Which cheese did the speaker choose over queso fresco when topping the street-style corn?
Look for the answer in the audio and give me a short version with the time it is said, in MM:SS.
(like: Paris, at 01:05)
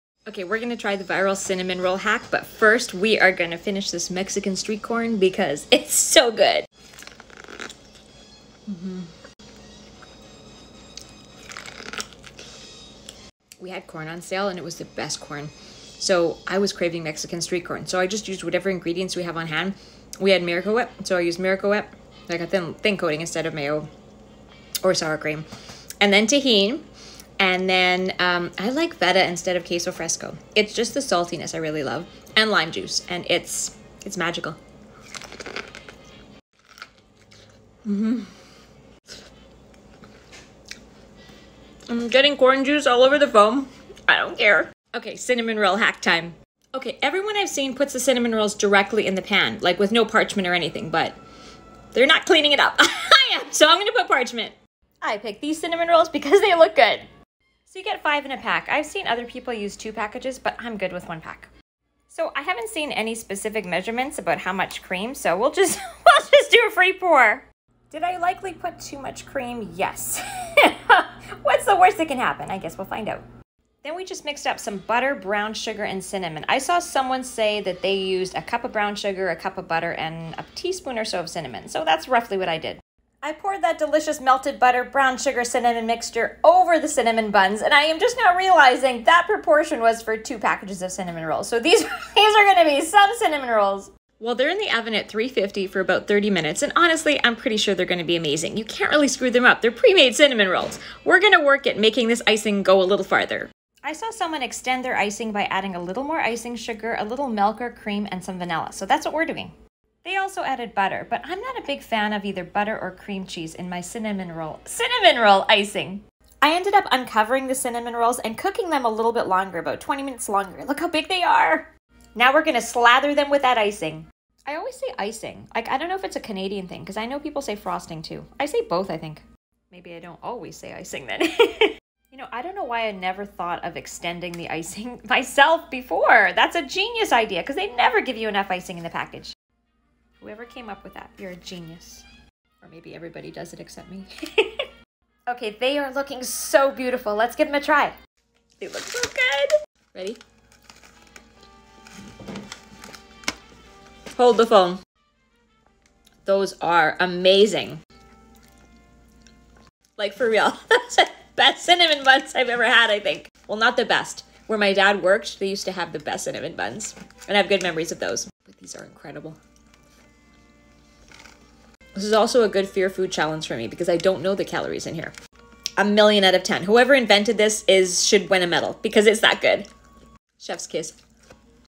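Feta, at 00:28.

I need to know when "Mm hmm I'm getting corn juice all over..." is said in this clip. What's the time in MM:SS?
00:37.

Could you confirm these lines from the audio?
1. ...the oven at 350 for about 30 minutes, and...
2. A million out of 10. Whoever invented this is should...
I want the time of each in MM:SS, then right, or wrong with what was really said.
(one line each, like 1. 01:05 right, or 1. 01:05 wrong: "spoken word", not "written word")
1. 01:34 right
2. 02:55 right.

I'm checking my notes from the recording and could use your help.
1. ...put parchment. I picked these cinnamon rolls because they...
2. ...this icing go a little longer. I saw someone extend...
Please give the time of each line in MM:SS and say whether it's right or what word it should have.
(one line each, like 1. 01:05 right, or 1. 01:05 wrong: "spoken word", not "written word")
1. 00:53 right
2. 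01:42 wrong: "farther", not "longer".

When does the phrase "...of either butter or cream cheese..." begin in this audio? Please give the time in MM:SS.
01:52.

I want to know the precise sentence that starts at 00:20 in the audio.
We had Miracle Whip, so I used Miracle Whip, like a thin, thin coating instead of mayo or sour cream.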